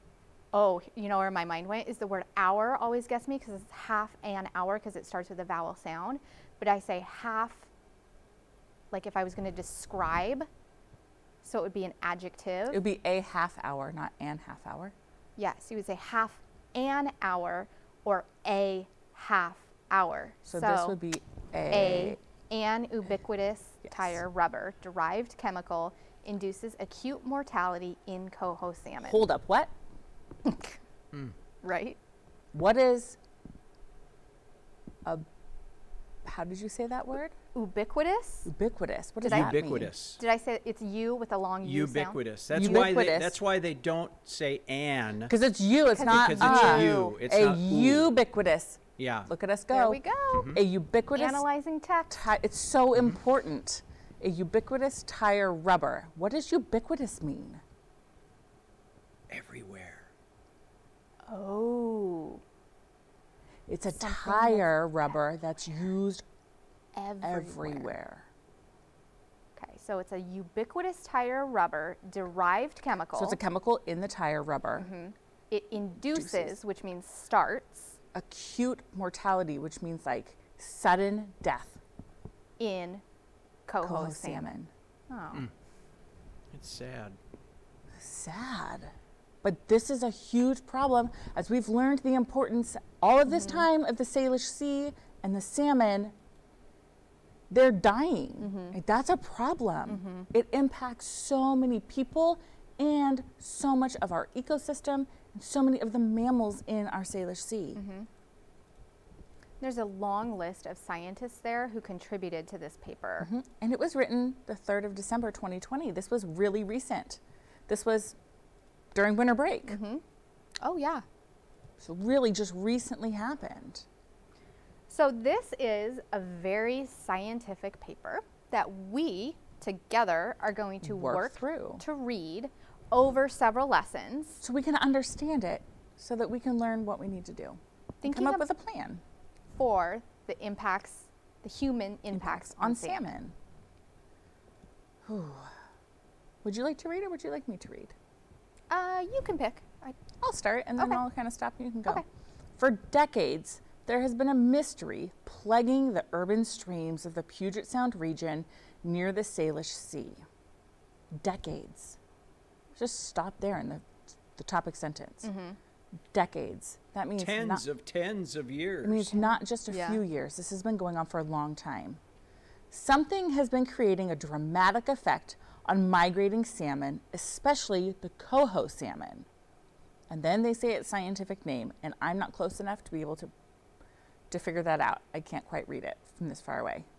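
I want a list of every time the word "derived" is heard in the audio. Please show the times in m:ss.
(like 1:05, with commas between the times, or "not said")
0:24, 1:12.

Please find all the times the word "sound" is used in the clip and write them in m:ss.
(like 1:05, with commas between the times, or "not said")
0:05, 0:42, 2:37.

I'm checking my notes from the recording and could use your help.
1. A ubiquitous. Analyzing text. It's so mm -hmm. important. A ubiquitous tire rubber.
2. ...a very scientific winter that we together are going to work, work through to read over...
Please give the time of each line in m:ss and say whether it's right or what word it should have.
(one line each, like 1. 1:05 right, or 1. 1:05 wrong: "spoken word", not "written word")
1. 0:50 right
2. 2:06 wrong: "paper", not "winter".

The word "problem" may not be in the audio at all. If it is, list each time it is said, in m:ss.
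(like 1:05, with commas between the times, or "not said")
1:30, 1:39.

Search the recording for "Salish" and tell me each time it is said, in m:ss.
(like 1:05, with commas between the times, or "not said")
1:34, 1:47, 2:39.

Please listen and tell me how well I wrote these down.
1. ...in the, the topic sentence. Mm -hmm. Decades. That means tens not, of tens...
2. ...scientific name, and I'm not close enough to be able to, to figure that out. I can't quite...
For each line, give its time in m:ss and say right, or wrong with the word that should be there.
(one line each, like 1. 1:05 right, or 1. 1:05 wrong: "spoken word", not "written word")
1. 2:43 right
2. 3:00 right.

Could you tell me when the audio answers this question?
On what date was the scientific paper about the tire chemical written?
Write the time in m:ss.
1:54.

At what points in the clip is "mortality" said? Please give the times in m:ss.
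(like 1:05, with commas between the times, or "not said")
0:27, 1:18.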